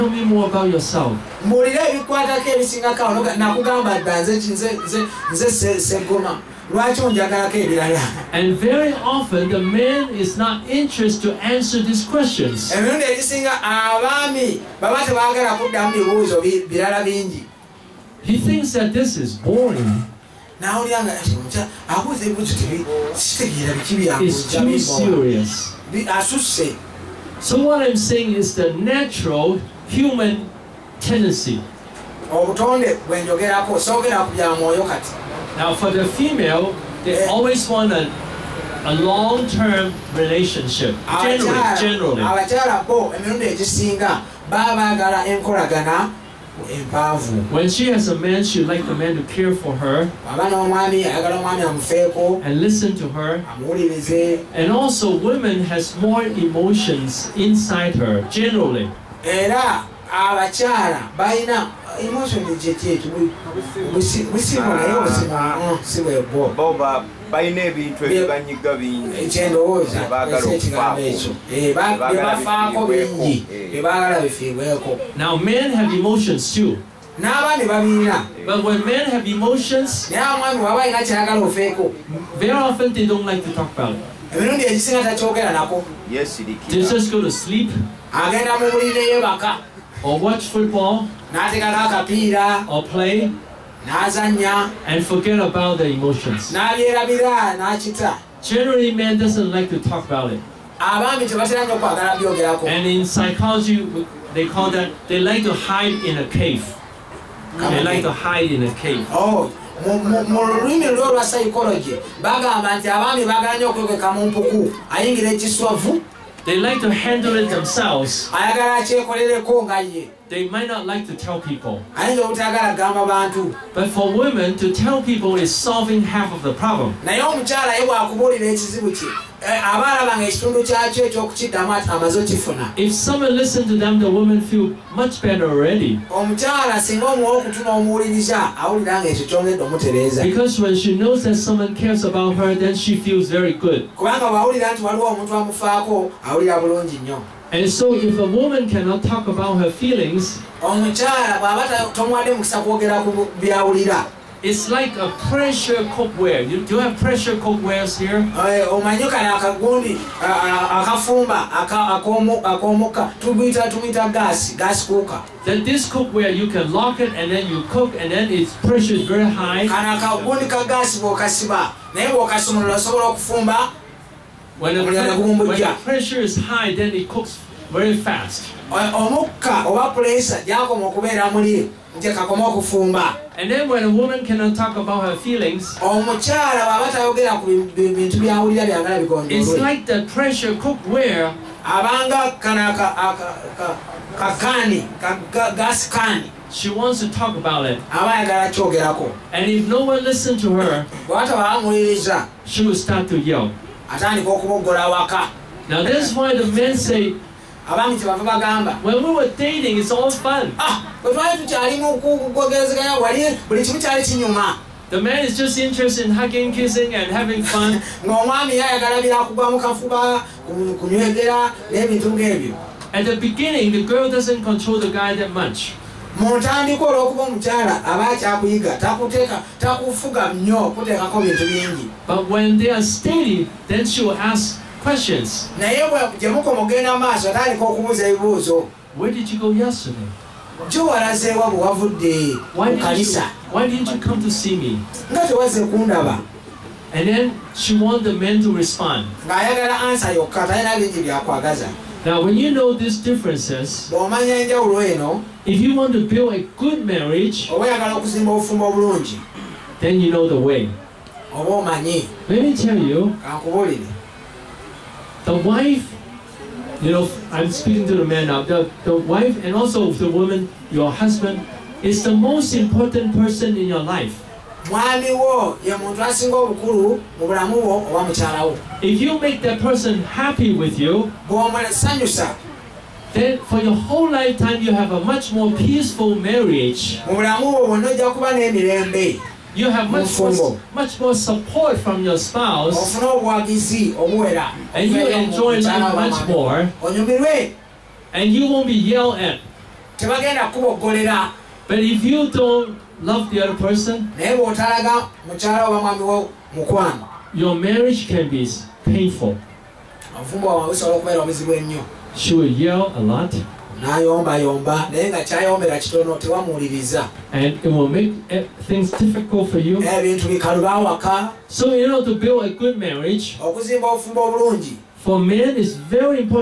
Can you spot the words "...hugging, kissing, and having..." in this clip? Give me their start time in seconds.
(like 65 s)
216 s.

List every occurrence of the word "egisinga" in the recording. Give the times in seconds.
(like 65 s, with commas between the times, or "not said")
13 s, 84 s.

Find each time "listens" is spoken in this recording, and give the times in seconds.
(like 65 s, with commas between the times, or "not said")
133 s, 200 s.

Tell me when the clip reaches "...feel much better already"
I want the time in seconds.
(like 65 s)
134 s.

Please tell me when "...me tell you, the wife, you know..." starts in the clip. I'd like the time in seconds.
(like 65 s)
262 s.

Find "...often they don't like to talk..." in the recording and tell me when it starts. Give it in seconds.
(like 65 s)
82 s.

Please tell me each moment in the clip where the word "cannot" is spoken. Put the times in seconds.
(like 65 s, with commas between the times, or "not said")
148 s, 184 s.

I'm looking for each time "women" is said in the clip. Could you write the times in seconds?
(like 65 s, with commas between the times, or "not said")
124 s, 134 s.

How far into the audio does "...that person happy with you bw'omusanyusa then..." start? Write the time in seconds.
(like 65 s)
279 s.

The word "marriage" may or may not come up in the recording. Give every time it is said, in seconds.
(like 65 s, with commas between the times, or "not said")
256 s, 286 s, 307 s, 322 s.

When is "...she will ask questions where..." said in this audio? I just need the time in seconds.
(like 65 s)
233 s.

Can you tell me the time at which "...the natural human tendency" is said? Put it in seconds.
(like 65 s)
28 s.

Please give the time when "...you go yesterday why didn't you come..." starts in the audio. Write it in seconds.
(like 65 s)
239 s.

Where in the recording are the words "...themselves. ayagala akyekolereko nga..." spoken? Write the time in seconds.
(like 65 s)
117 s.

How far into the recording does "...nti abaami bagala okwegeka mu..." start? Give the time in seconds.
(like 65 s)
112 s.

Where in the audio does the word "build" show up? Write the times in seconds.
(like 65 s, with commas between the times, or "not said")
256 s, 322 s.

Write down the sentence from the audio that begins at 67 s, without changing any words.
ebintu ebibanyiga bingi ekyendowooza ekyo eh, bingi eh.